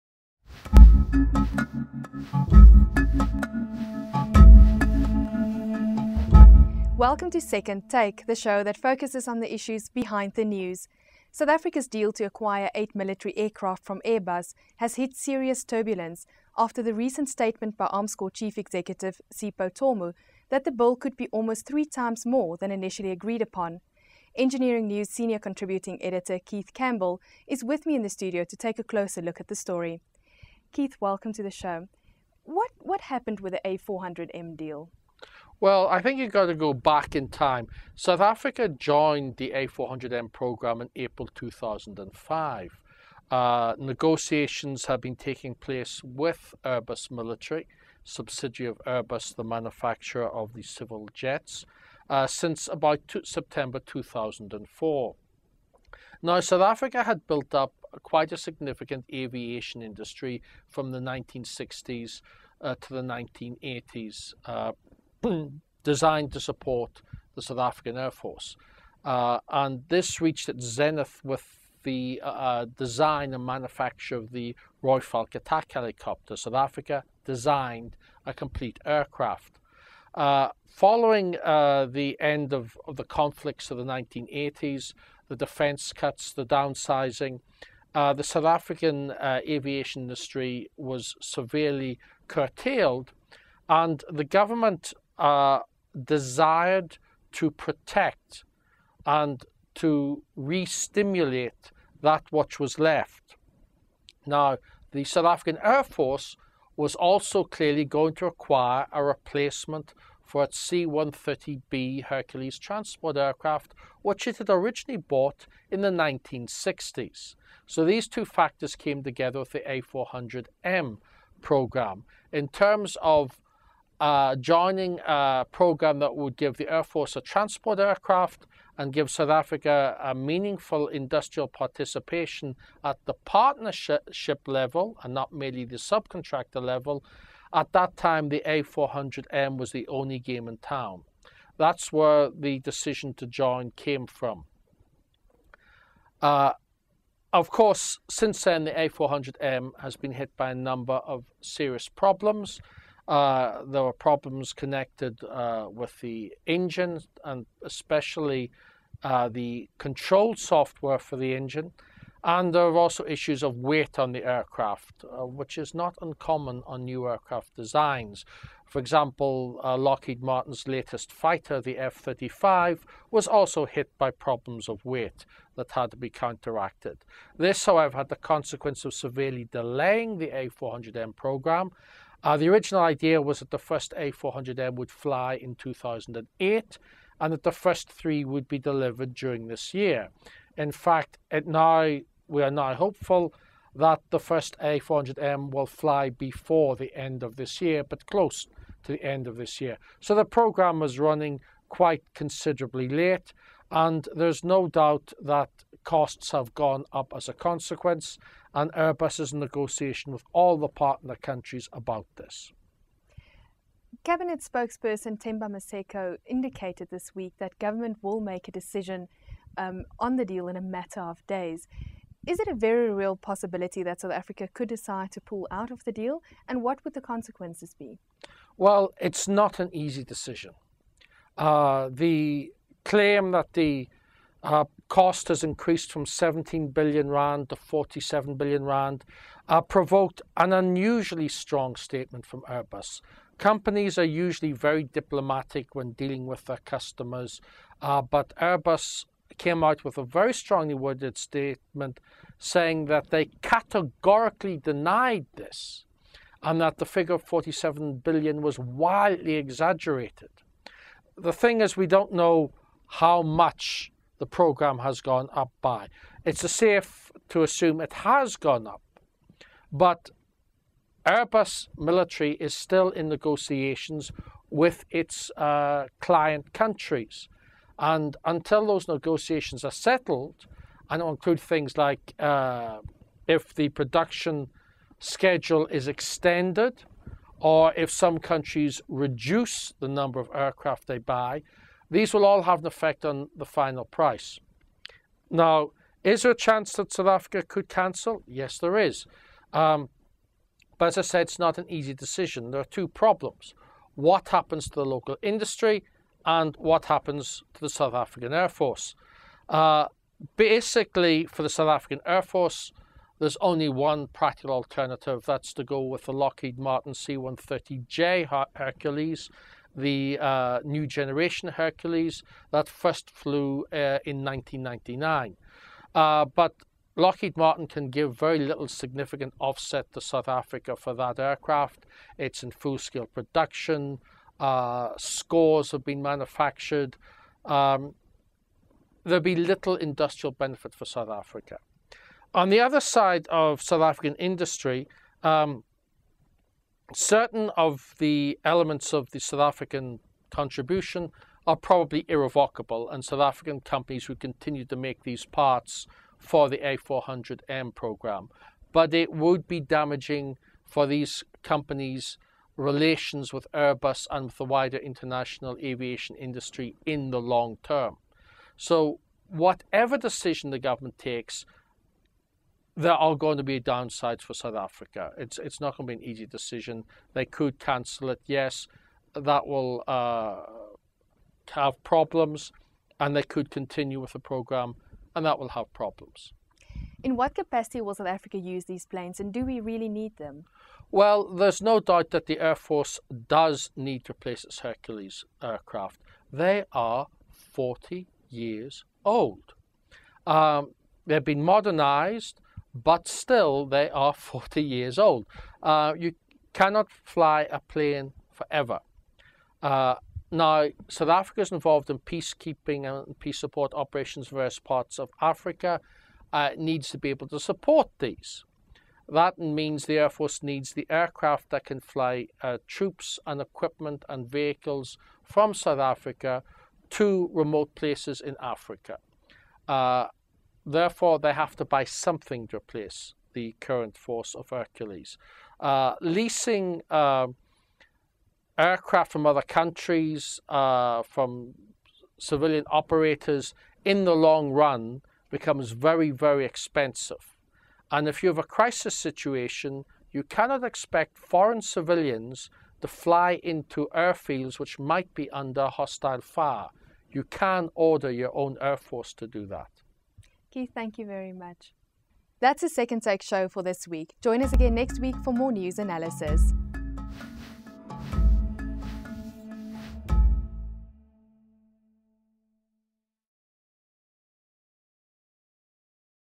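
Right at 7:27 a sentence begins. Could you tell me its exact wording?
And if you have a crisis situation, you cannot expect foreign civilians to fly into airfields which might be under hostile fire.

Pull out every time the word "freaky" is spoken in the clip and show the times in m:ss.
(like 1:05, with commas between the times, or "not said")
not said.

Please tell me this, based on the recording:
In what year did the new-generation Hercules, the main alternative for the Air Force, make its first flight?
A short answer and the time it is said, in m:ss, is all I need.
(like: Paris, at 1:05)
1999, at 5:24.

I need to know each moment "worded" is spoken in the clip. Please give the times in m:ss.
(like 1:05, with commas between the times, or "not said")
4:10.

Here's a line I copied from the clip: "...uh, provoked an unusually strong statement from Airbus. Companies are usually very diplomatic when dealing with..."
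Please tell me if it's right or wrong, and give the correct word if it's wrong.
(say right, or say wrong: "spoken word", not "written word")
right.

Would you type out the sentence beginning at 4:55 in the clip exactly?
Now, is there a chance that South Africa could cancel?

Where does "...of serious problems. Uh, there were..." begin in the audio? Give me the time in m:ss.
2:30.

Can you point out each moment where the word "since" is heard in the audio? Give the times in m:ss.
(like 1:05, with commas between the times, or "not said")
0:52, 2:28.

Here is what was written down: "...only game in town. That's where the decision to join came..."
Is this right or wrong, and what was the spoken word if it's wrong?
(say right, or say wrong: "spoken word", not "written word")
right.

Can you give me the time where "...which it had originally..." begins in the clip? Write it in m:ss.
1:54.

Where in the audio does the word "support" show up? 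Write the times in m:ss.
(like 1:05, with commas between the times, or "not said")
1:06, 6:53, 6:57.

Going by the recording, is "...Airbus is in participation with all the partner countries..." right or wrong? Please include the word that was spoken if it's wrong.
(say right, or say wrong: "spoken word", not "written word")
wrong: "negotiation", not "participation".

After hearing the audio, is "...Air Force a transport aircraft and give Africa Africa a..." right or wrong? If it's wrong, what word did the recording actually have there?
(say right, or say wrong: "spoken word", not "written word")
wrong: "South", not "Africa".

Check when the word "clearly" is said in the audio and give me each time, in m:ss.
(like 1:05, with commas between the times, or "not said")
1:47.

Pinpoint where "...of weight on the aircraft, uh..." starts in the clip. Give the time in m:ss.
2:43.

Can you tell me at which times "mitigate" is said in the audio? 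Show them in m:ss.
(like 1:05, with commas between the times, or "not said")
not said.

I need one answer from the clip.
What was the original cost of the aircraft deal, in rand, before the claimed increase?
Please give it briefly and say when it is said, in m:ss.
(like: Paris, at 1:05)
17 billion rand, at 3:56.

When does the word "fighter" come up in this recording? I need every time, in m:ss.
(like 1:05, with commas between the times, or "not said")
2:51.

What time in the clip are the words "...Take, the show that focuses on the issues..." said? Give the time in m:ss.
0:07.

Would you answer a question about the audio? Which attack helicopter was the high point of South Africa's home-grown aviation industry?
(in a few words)
Royal Falk.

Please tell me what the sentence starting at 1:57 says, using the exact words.
So these two factors came together with the A400M program.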